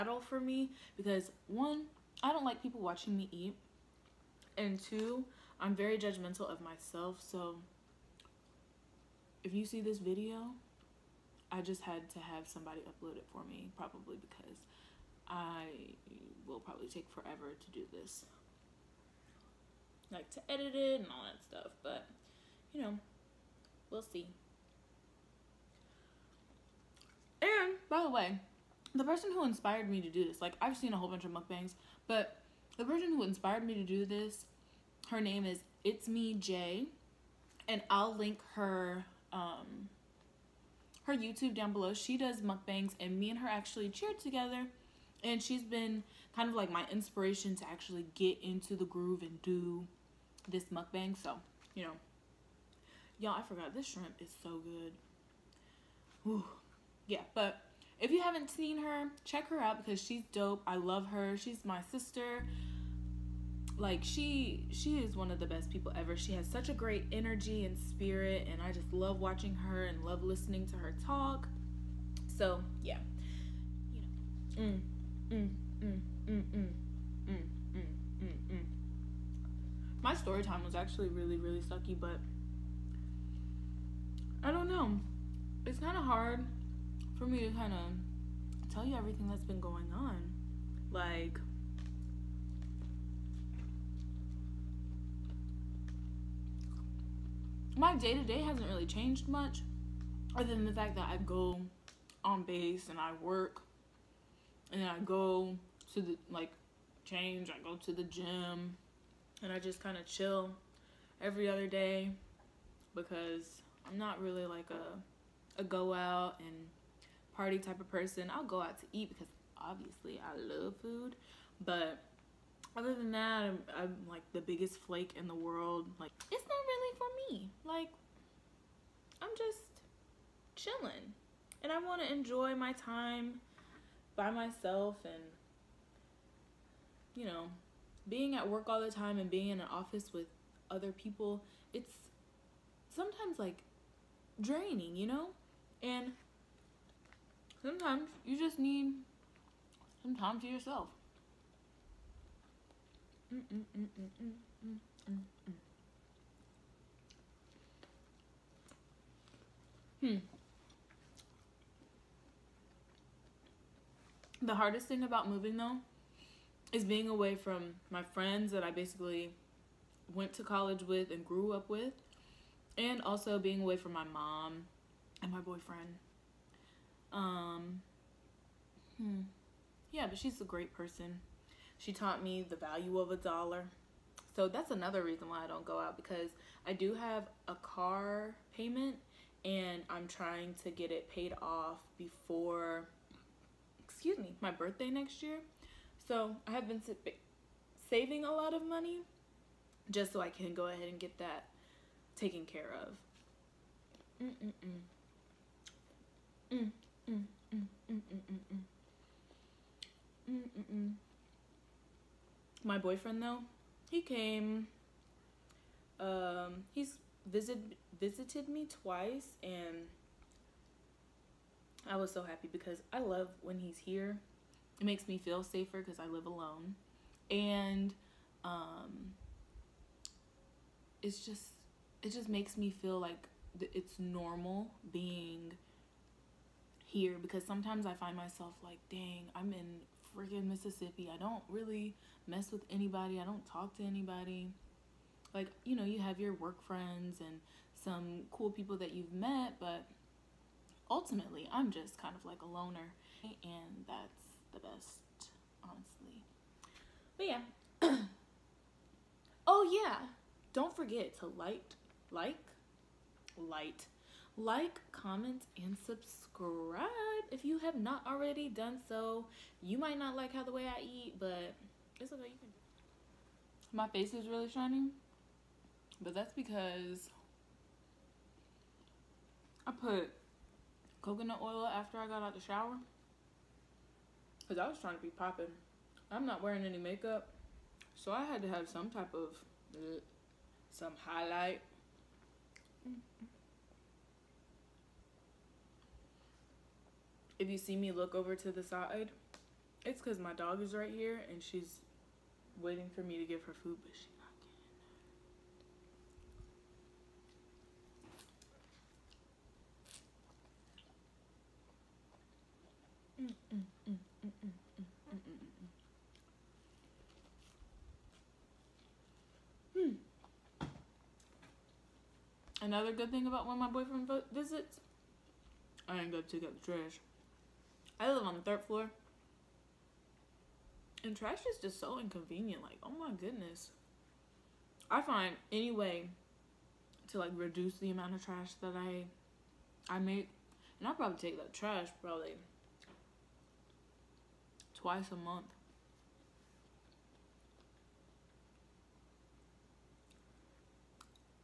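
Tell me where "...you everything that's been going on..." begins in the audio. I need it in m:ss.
1:28.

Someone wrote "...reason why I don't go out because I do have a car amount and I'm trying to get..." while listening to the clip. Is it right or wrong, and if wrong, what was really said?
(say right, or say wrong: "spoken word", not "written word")
wrong: "payment", not "amount".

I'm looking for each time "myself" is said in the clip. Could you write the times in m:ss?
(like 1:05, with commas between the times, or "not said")
0:06, 2:14, 3:58.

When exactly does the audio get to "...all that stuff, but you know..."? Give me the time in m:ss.
0:21.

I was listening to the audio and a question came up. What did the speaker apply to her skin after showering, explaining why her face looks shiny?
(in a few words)
Coconut oil.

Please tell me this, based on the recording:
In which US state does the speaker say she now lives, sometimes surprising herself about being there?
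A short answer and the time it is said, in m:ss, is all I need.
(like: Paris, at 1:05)
Mississippi, at 4:00.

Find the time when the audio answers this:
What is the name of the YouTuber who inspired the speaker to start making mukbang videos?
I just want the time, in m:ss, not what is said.
0:35.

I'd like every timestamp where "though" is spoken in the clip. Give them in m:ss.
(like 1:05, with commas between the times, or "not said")
2:45, 3:33.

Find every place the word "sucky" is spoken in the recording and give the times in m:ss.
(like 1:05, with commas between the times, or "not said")
1:21.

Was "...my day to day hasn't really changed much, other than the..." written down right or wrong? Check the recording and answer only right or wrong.
right.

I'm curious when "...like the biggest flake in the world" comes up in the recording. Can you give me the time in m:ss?
2:04.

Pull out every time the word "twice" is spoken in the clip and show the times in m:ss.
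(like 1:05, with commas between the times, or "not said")
3:38, 5:44.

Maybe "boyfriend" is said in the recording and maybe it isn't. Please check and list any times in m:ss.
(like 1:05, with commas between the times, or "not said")
2:55, 3:32, 5:23.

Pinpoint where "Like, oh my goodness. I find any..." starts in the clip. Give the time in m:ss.
5:32.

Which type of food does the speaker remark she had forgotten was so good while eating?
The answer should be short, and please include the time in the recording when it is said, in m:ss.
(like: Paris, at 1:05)
Shrimp, at 0:53.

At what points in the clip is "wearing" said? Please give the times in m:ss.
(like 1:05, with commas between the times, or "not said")
4:46.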